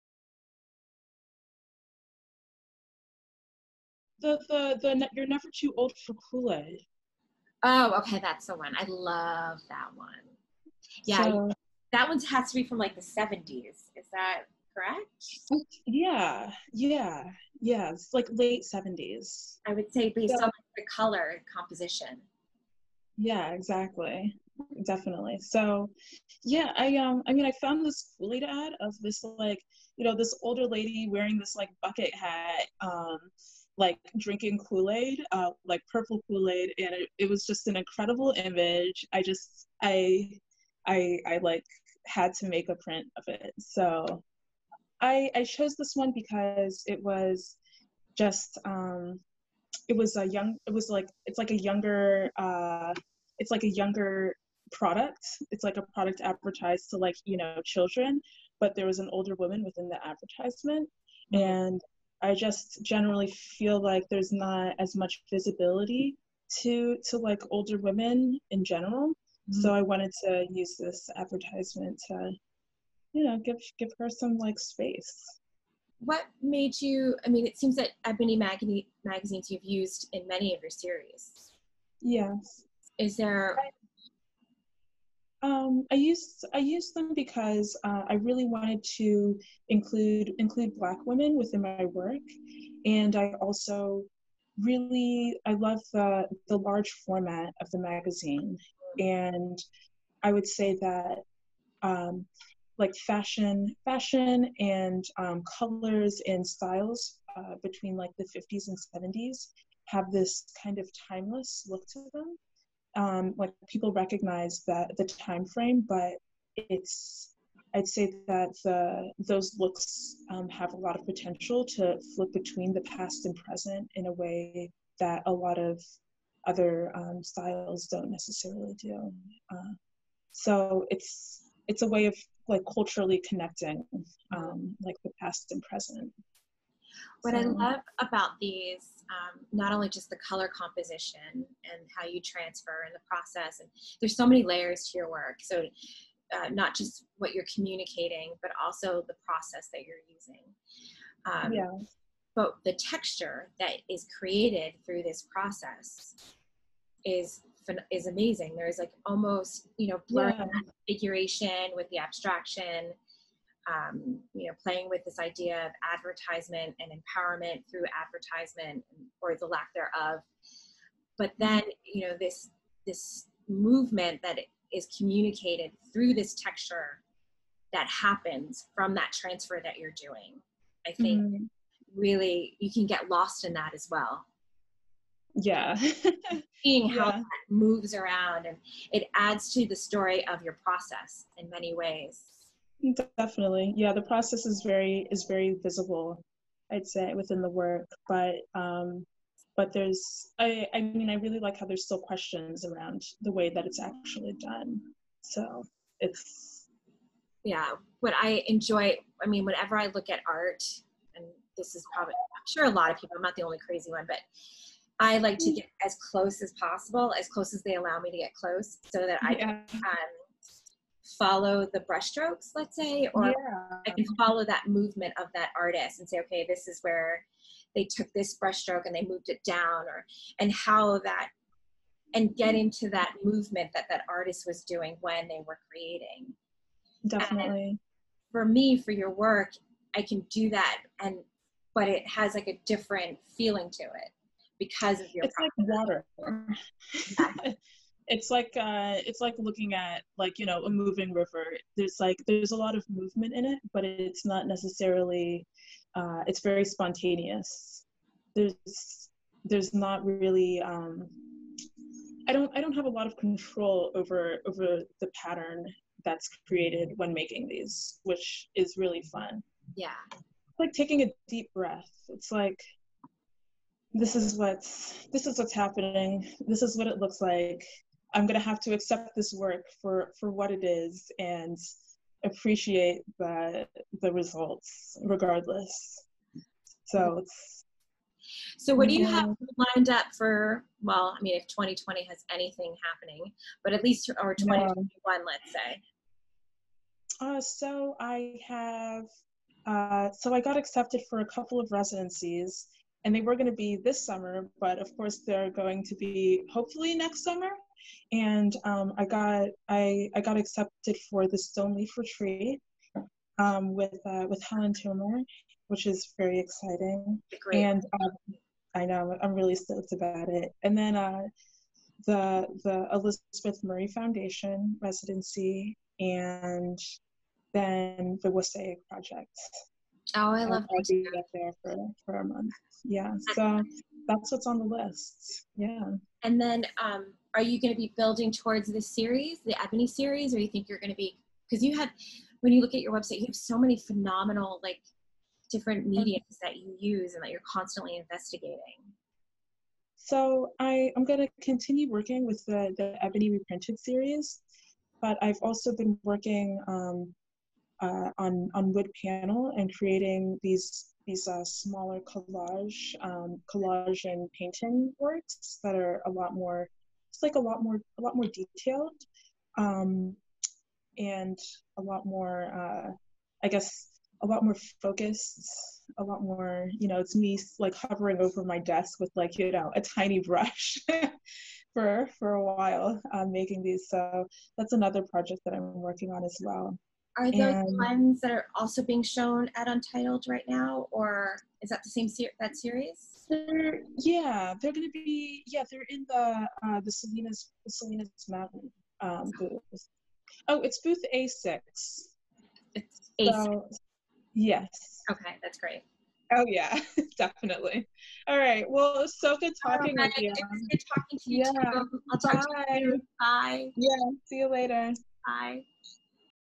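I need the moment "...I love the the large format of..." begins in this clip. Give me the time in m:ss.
1:35.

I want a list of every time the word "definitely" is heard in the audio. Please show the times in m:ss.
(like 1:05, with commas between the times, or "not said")
0:24, 3:13, 3:57, 6:47.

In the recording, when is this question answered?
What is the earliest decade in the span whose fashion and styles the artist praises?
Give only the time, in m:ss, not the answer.
1:48.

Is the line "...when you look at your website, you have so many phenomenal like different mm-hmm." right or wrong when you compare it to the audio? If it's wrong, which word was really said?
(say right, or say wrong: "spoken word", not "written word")
right.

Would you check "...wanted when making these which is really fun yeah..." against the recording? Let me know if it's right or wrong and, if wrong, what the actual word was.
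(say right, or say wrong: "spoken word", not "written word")
wrong: "created", not "wanted".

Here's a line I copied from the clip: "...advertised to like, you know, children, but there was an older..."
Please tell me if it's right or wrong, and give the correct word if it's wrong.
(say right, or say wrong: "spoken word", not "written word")
right.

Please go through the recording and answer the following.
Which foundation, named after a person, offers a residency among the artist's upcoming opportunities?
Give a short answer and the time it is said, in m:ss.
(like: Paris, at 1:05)
Elizabeth Murray Foundation, at 5:22.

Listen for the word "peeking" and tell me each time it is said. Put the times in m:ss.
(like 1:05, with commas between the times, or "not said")
not said.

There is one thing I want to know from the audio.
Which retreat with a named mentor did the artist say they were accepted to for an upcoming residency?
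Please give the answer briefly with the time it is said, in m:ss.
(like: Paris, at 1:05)
Stoneleaf Retreat, at 5:11.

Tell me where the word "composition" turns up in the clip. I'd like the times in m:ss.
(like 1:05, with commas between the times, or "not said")
0:21, 2:20.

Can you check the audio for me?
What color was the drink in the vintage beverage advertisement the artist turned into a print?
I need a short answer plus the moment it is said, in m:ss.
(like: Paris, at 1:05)
Purple, at 0:35.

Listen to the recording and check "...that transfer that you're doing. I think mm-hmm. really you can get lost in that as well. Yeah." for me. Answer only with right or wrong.
right.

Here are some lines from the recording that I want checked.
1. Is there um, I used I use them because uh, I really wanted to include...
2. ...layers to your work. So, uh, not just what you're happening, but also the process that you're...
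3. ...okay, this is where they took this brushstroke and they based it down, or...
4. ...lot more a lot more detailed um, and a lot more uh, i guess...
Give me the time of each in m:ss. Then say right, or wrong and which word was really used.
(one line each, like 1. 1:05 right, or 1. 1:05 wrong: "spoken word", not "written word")
1. 1:22 right
2. 2:24 wrong: "communicating", not "happening"
3. 3:46 wrong: "moved", not "based"
4. 6:07 right.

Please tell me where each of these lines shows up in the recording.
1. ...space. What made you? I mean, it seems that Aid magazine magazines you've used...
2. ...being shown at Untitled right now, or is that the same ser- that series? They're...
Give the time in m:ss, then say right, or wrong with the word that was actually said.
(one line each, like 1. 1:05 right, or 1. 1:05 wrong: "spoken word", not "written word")
1. 1:14 wrong: "Ebony", not "Aid"
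2. 6:28 right.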